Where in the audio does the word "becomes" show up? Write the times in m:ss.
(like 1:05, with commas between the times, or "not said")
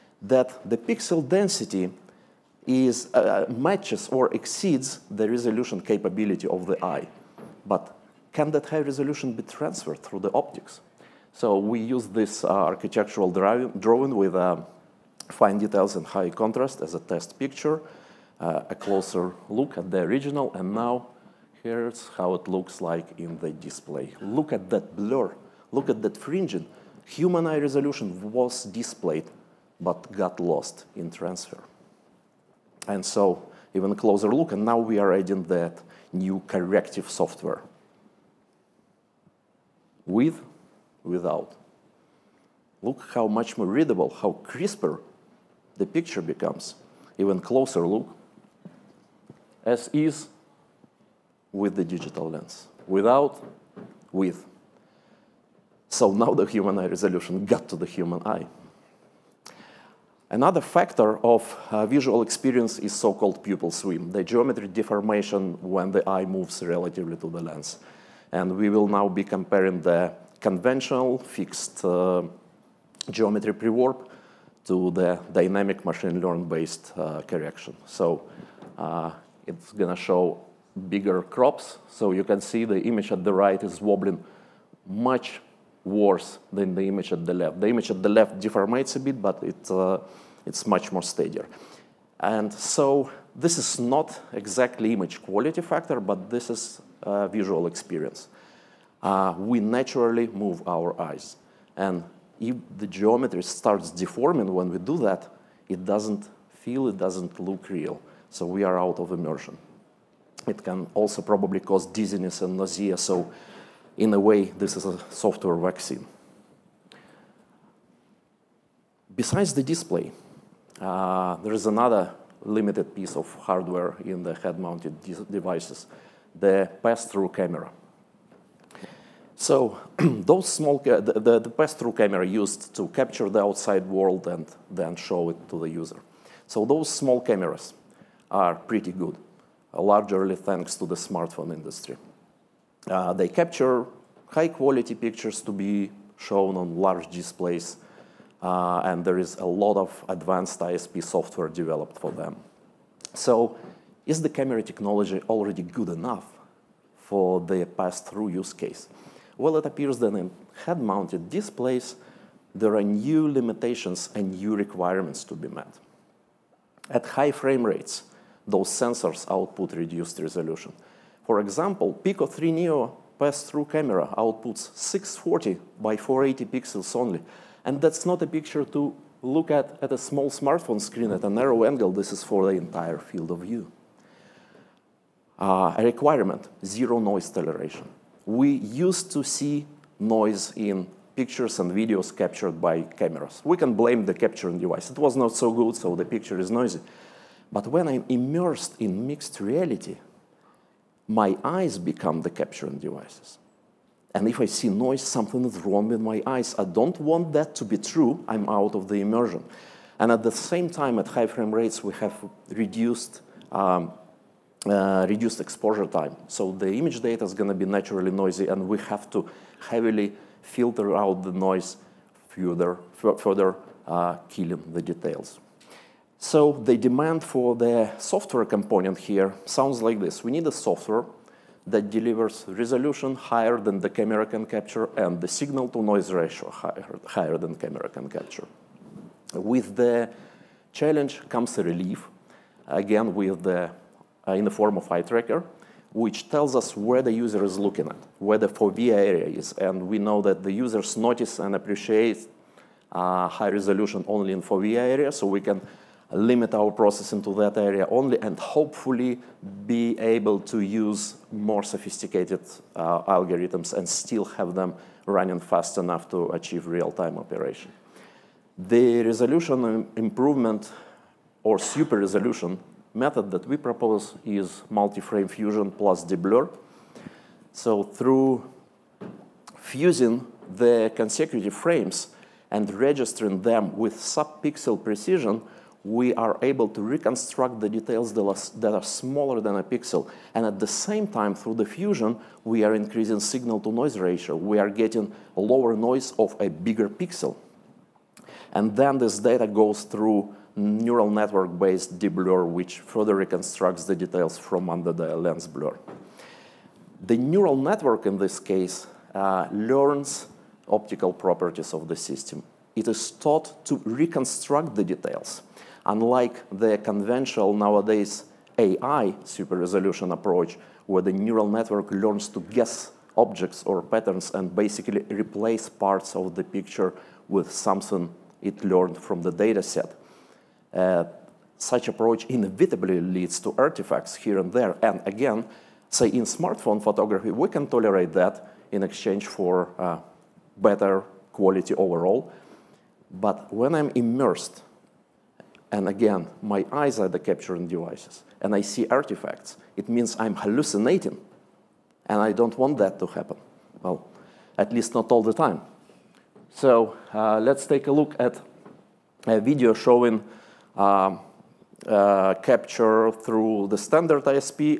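0:46, 3:21.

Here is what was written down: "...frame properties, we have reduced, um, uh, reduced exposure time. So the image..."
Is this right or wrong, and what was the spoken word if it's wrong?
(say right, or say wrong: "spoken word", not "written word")
wrong: "rates", not "properties".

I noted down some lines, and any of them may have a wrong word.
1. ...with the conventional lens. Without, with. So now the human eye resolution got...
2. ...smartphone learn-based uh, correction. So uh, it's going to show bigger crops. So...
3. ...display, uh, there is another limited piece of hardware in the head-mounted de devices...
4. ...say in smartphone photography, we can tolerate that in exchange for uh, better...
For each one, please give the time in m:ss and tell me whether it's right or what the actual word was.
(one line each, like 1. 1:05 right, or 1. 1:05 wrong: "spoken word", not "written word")
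1. 0:51 wrong: "digital", not "conventional"
2. 1:15 wrong: "machine", not "smartphone"
3. 1:59 right
4. 5:35 right.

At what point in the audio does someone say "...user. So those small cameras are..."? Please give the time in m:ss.
2:15.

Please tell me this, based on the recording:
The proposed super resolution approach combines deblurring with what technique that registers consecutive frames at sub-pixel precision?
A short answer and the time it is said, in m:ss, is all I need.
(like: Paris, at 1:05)
multi-frame fusion, at 4:34.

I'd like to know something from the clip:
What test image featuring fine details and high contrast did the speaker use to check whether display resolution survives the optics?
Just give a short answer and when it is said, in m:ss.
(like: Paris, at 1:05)
architectural drawing, at 0:12.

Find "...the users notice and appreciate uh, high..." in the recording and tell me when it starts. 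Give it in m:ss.
4:10.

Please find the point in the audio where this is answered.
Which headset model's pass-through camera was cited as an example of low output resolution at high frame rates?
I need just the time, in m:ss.
2:51.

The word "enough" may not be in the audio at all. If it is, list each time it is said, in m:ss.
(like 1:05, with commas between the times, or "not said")
2:35, 4:25.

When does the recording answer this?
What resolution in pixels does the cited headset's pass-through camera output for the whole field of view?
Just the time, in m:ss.
2:54.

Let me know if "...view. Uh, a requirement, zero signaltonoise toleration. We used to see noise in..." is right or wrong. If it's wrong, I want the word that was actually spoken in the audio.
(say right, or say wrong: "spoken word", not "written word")
wrong: "noise", not "signaltonoise".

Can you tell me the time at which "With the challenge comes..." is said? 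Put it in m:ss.
3:59.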